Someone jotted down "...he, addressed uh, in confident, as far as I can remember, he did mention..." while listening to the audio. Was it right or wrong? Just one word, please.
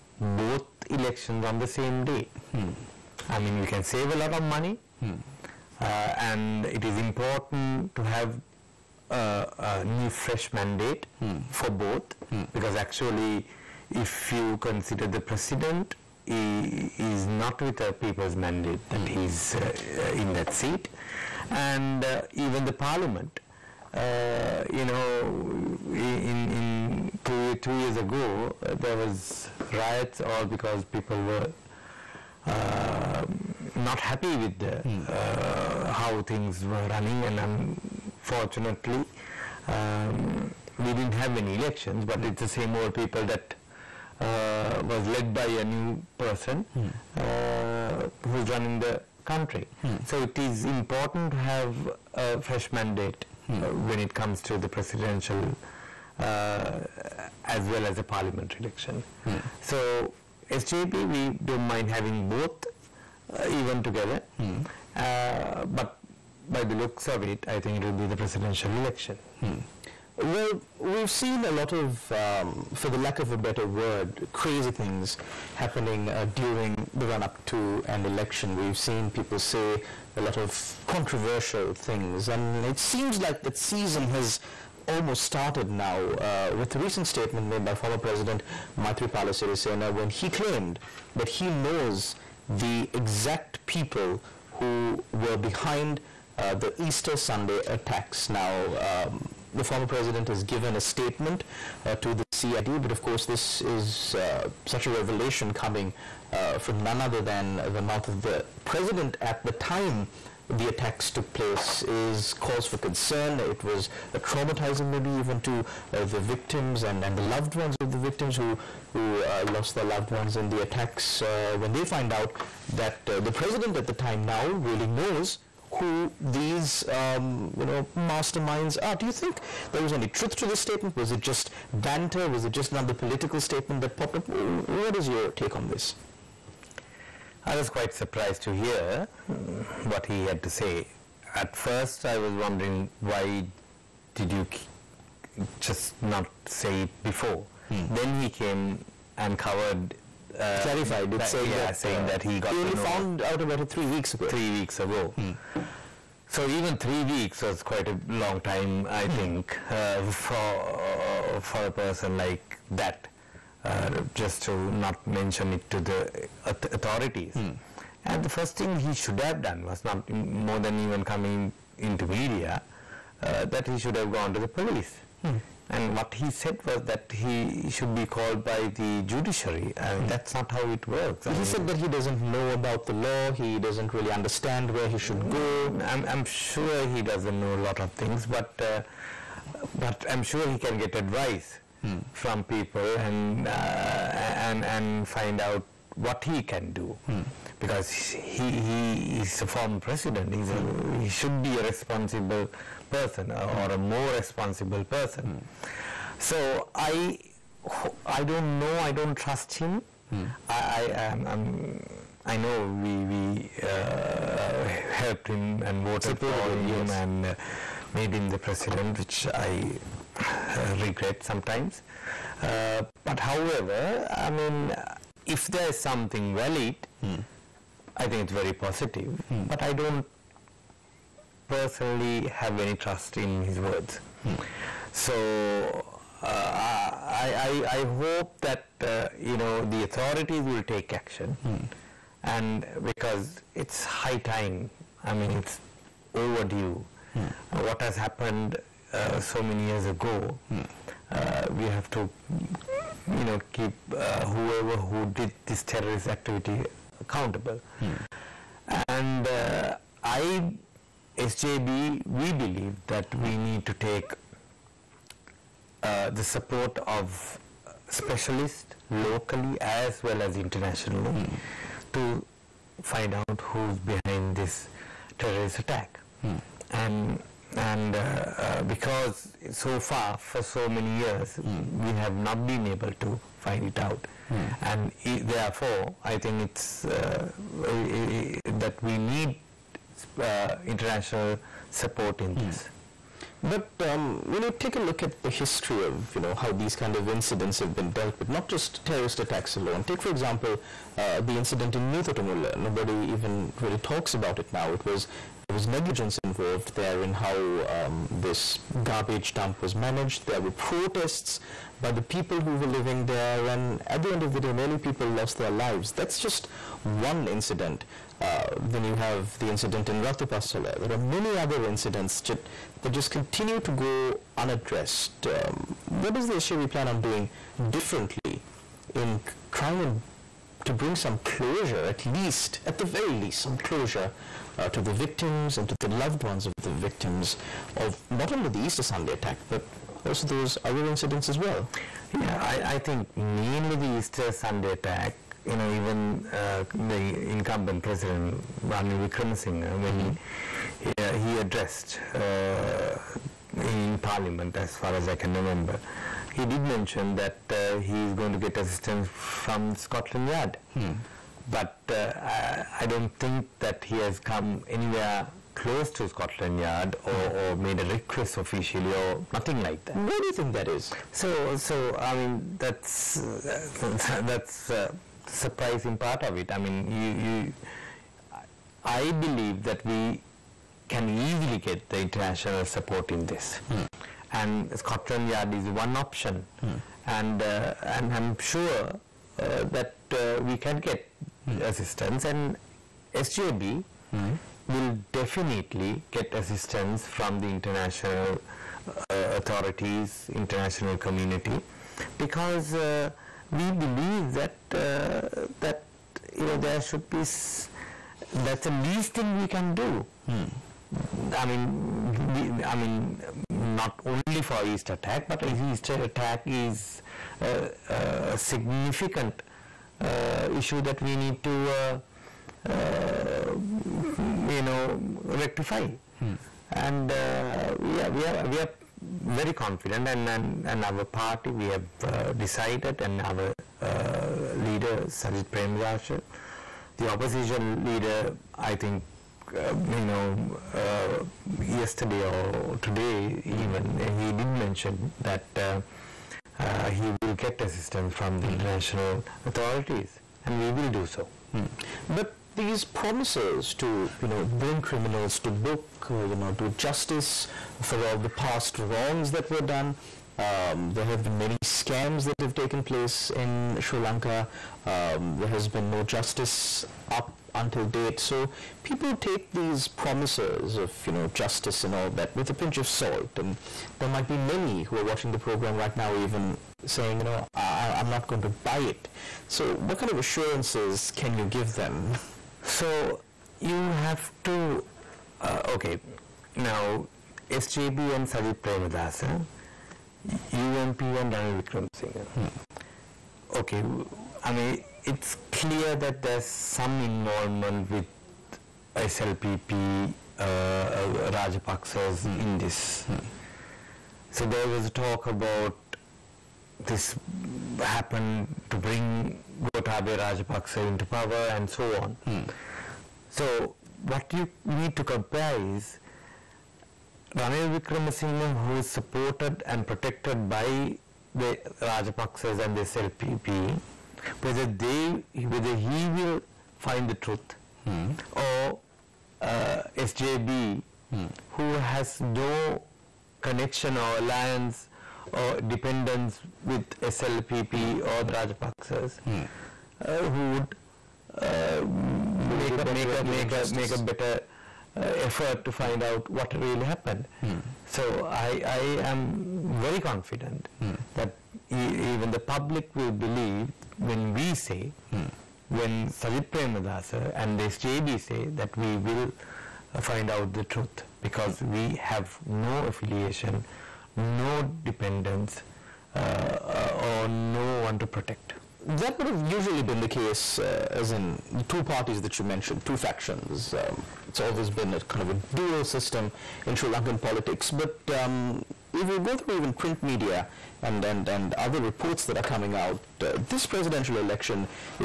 wrong.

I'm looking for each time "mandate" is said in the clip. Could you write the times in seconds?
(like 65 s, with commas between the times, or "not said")
10 s, 18 s, 52 s.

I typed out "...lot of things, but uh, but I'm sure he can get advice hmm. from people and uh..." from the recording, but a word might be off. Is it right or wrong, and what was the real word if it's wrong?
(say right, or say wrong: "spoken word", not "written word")
right.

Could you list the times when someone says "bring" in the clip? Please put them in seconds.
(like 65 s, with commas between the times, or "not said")
330 s, 454 s, 508 s.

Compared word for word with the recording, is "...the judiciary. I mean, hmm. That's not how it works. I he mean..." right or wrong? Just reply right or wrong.
right.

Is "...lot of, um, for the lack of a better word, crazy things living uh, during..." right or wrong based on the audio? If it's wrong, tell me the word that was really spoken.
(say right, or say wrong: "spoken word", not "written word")
wrong: "happening", not "living".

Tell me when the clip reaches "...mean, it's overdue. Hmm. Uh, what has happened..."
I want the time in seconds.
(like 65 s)
245 s.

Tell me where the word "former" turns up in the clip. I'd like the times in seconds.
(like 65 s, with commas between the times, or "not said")
87 s, 99 s, 199 s.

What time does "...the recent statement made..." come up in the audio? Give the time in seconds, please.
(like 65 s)
86 s.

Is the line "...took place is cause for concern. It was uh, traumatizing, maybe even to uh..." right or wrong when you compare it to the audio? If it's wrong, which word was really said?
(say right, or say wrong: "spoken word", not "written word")
right.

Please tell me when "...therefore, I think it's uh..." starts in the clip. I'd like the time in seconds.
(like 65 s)
285 s.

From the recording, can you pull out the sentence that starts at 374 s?
that's uh, surprising part of it.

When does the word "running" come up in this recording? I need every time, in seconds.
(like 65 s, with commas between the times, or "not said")
36 s, 48 s.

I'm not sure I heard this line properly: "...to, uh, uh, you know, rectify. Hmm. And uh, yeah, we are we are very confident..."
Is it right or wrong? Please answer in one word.
right.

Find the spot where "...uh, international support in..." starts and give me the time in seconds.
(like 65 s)
290 s.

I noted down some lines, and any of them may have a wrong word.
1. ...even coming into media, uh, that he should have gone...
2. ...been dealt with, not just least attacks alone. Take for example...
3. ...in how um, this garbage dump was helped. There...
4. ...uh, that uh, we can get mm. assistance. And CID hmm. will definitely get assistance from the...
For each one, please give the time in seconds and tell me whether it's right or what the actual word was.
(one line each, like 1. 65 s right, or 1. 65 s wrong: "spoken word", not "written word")
1. 170 s right
2. 297 s wrong: "terrorist", not "least"
3. 307 s wrong: "managed", not "helped"
4. 389 s wrong: "SJB", not "CID".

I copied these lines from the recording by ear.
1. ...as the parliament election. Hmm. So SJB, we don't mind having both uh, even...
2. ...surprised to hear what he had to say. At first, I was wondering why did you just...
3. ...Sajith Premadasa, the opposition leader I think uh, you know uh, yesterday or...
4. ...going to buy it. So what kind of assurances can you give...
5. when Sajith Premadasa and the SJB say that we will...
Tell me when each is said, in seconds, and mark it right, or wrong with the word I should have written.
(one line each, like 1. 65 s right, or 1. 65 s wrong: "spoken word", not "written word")
1. 57 s right
2. 137 s right
3. 435 s right
4. 478 s right
5. 555 s right.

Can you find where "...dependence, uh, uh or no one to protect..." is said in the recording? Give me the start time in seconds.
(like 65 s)
564 s.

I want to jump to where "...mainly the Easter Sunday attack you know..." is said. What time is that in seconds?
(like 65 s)
343 s.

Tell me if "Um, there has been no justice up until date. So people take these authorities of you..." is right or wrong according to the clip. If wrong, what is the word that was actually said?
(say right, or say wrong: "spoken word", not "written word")
wrong: "promises", not "authorities".